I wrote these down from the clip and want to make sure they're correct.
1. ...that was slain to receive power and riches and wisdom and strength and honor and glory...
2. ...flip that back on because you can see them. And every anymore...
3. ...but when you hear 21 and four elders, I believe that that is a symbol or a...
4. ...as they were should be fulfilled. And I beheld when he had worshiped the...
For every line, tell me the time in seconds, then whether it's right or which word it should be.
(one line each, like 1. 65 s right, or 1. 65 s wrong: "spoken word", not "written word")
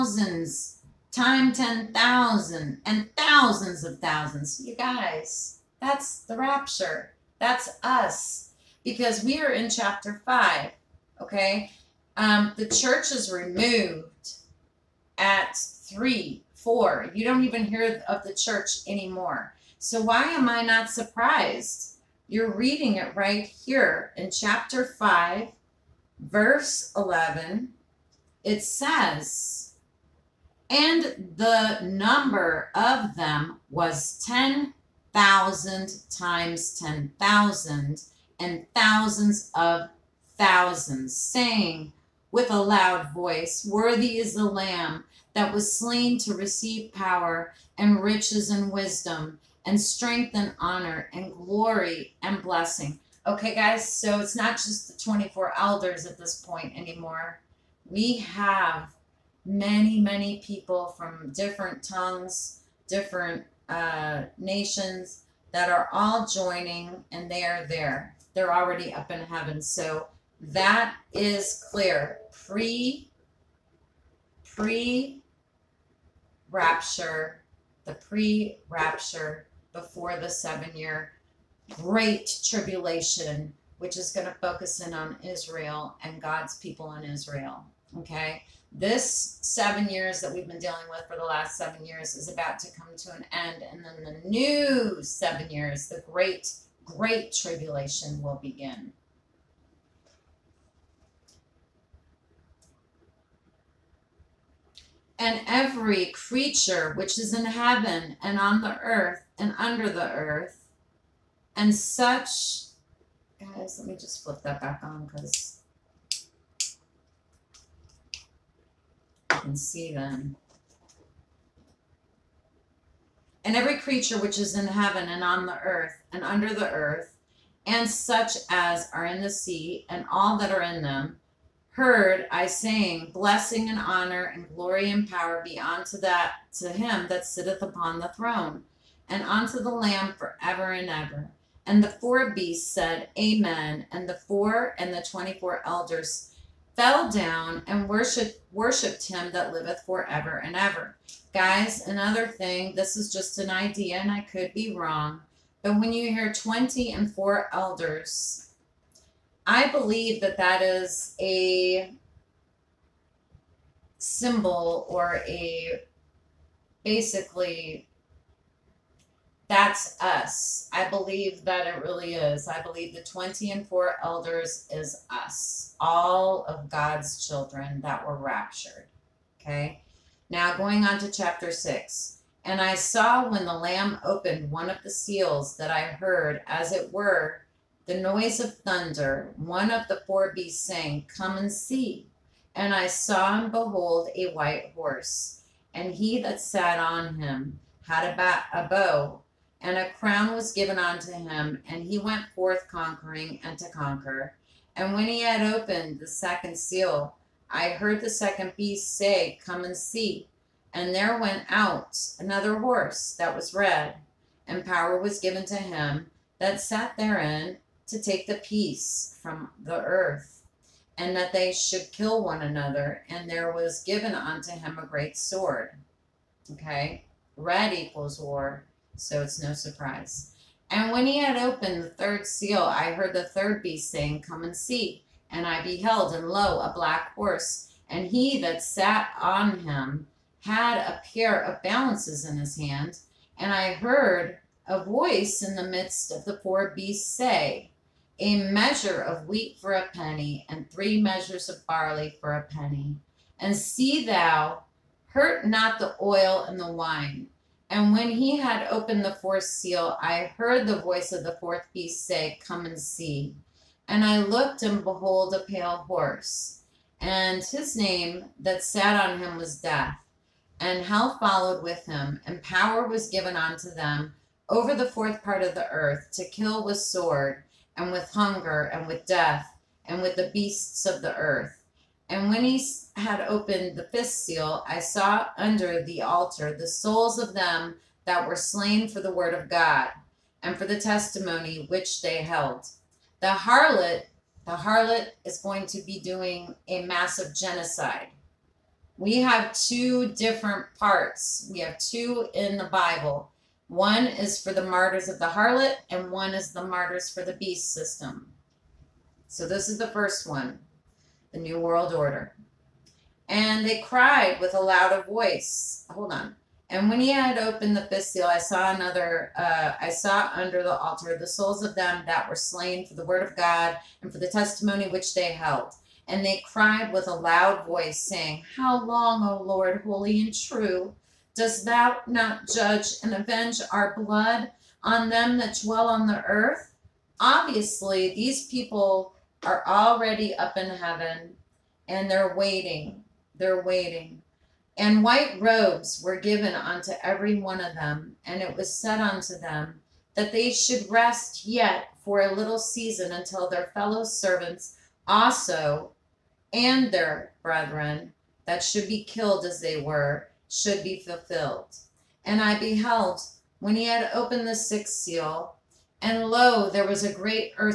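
1. 45 s right
2. 114 s wrong: "creature", not "anymore"
3. 155 s wrong: "20", not "21"
4. 359 s wrong: "opened", not "worshiped".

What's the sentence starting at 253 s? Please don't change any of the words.
And see thou, hurt not the oil and the wine.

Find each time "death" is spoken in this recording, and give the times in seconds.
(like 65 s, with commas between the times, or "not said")
269 s, 279 s.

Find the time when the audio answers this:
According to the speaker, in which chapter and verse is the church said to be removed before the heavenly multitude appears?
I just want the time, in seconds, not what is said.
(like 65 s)
15 s.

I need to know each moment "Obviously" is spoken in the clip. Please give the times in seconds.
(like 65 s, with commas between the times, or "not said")
337 s.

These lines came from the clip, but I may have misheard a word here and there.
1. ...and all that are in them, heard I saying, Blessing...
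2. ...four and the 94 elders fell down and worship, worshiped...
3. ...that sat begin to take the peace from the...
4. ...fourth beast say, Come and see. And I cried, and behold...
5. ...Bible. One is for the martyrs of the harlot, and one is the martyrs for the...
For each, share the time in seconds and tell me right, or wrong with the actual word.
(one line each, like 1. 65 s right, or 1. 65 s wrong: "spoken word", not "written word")
1. 129 s right
2. 144 s wrong: "24", not "94"
3. 216 s wrong: "therein", not "begin"
4. 261 s wrong: "looked", not "cried"
5. 302 s right.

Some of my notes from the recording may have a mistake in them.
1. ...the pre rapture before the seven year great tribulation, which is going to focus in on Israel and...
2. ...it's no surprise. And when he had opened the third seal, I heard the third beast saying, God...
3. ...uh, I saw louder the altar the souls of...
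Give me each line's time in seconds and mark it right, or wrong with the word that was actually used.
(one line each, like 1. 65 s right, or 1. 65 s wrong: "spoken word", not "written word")
1. 77 s right
2. 229 s wrong: "Come", not "God"
3. 319 s wrong: "under", not "louder".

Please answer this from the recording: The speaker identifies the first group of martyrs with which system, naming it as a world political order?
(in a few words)
The New World Order.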